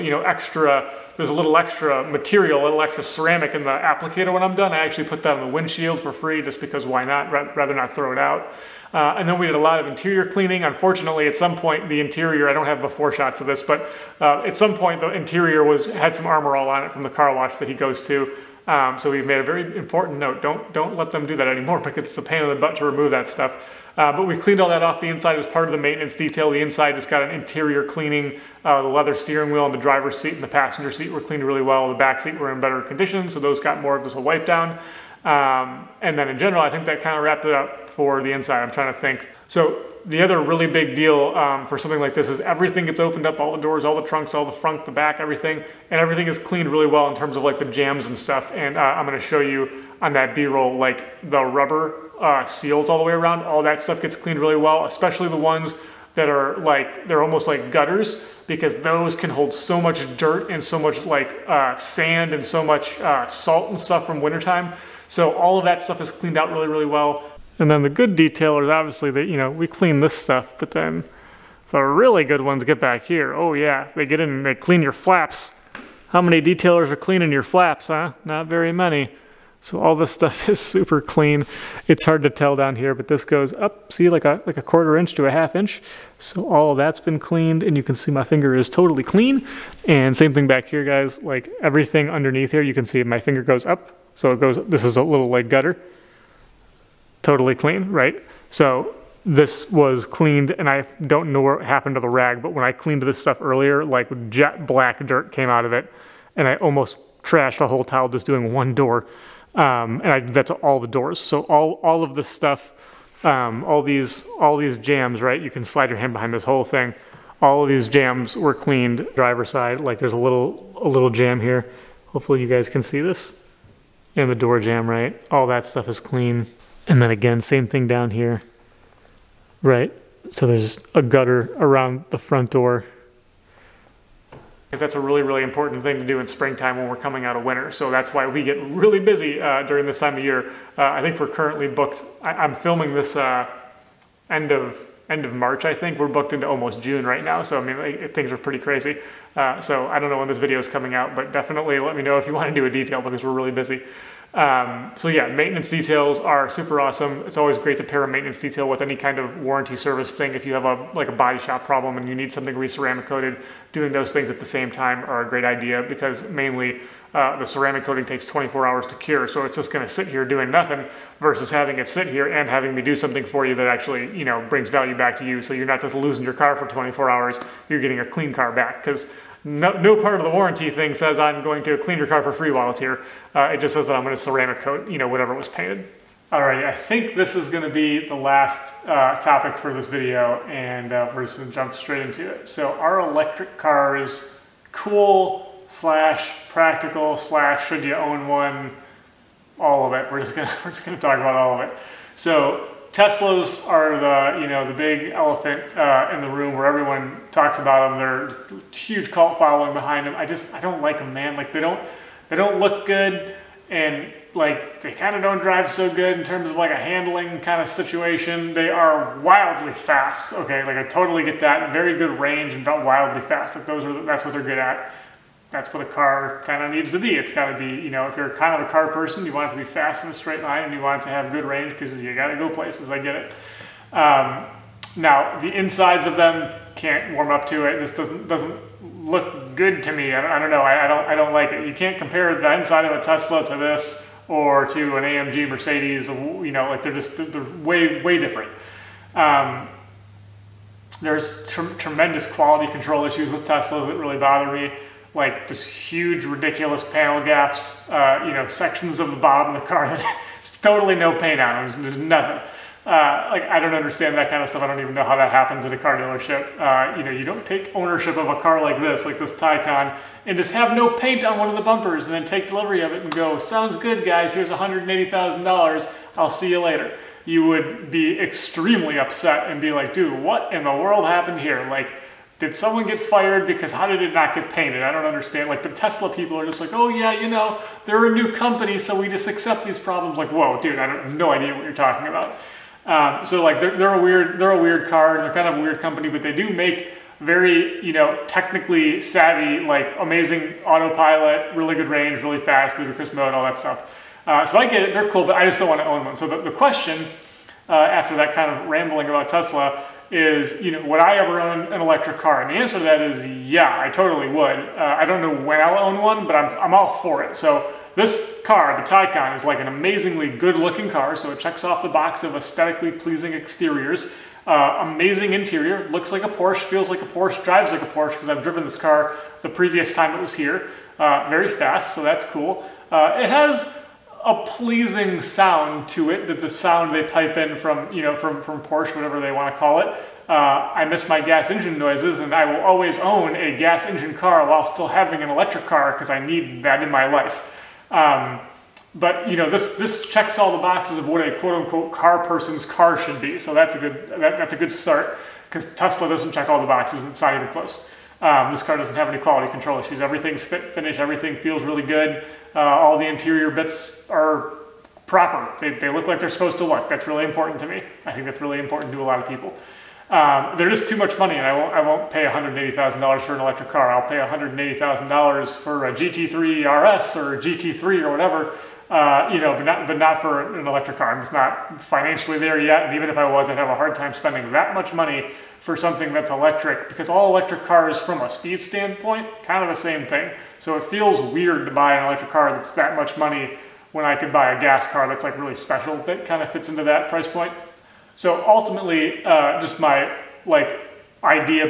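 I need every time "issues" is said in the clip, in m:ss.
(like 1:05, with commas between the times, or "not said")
4:13, 5:59.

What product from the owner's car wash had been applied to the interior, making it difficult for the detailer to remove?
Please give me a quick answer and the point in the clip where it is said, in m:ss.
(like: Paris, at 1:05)
Armor All, at 0:16.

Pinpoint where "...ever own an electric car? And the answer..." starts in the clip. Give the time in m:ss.
5:11.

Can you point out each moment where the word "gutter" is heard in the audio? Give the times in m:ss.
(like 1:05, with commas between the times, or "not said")
0:57, 1:35, 2:11.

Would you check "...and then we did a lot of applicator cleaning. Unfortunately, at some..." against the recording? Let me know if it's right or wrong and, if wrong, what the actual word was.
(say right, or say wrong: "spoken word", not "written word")
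wrong: "interior", not "applicator".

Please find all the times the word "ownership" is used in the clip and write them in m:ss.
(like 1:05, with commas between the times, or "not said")
4:27.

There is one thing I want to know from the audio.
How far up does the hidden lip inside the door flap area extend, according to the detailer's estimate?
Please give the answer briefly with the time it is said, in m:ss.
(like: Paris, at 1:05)
a quarter inch to a half inch, at 1:24.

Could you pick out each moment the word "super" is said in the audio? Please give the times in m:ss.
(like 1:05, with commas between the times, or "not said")
1:20, 2:36.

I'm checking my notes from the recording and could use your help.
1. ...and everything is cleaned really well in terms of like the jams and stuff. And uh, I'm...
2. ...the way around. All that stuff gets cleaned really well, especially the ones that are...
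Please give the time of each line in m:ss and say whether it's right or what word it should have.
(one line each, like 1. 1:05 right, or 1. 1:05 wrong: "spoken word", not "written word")
1. 0:45 right
2. 0:52 right.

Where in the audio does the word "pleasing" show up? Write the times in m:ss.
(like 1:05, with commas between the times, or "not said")
5:22, 5:34.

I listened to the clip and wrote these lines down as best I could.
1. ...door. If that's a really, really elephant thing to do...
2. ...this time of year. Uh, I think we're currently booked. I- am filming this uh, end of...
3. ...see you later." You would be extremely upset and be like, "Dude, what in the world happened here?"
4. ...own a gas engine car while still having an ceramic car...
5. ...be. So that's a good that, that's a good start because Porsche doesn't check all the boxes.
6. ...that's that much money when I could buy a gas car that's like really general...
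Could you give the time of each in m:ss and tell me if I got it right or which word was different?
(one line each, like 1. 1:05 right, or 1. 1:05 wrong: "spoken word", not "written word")
1. 2:12 wrong: "important", not "elephant"
2. 2:19 right
3. 4:36 right
4. 5:42 wrong: "electric", not "ceramic"
5. 5:53 wrong: "Tesla", not "Porsche"
6. 6:32 wrong: "special", not "general".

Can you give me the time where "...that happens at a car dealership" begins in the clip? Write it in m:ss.
4:25.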